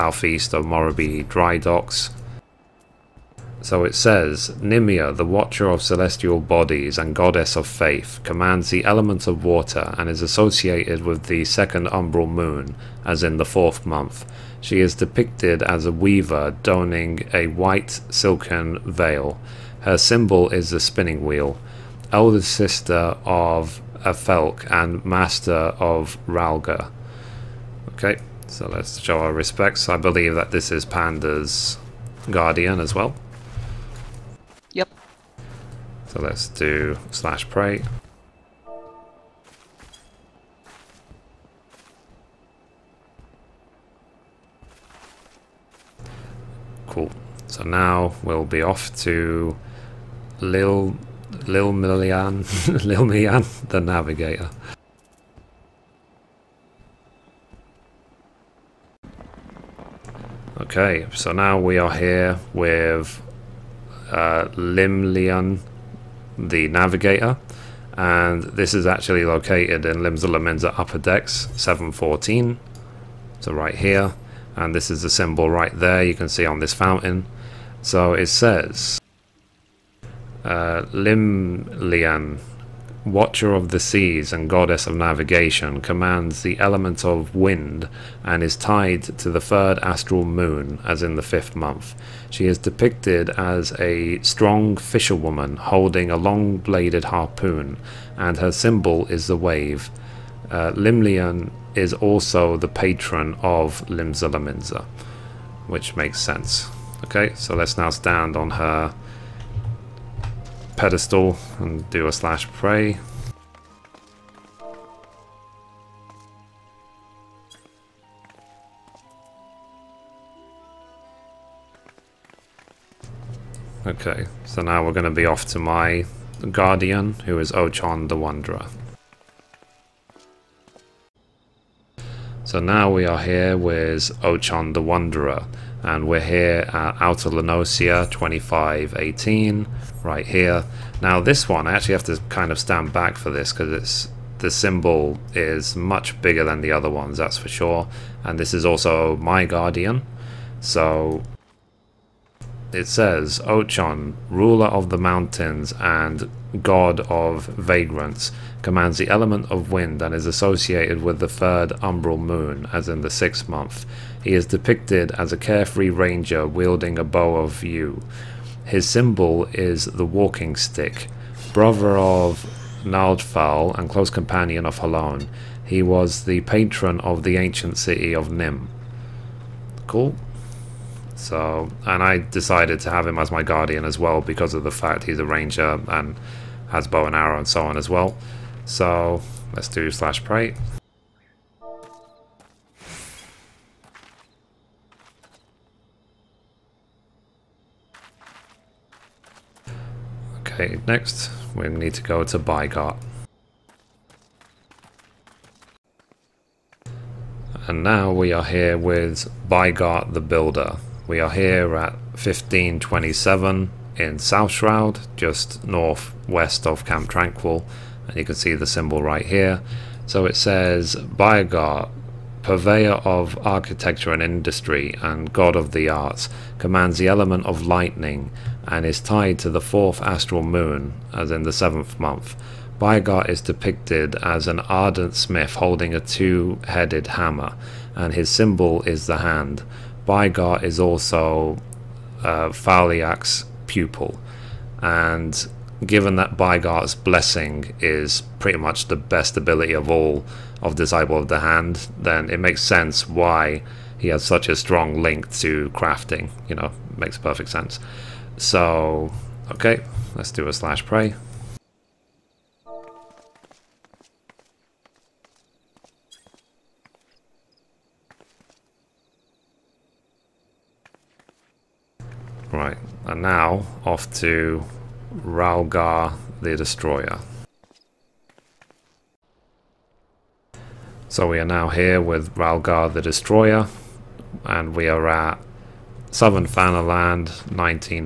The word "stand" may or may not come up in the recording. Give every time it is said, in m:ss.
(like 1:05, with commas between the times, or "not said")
1:47, 2:22.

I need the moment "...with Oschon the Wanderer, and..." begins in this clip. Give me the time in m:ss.
2:13.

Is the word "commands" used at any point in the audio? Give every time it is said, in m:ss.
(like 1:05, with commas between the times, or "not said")
0:08, 1:25, 2:38, 3:46.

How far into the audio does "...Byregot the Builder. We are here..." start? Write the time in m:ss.
3:29.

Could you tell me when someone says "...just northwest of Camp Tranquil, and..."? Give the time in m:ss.
3:35.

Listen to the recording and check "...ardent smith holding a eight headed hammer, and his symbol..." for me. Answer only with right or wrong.
wrong.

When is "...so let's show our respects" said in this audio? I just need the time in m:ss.
0:28.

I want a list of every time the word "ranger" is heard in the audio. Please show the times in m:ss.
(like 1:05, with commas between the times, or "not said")
2:45, 3:05.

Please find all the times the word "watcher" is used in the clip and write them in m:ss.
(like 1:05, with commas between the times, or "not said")
0:05, 1:23.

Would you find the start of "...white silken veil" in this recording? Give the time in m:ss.
0:17.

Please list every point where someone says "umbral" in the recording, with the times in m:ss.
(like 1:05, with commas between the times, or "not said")
0:11, 2:41.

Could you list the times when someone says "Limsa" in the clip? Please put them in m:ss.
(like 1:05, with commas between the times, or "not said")
1:09, 1:43.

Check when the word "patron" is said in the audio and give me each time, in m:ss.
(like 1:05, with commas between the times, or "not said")
1:42, 2:56.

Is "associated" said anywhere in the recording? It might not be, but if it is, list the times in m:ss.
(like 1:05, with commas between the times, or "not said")
0:10, 2:40.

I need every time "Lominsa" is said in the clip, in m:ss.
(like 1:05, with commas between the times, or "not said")
1:10, 1:44.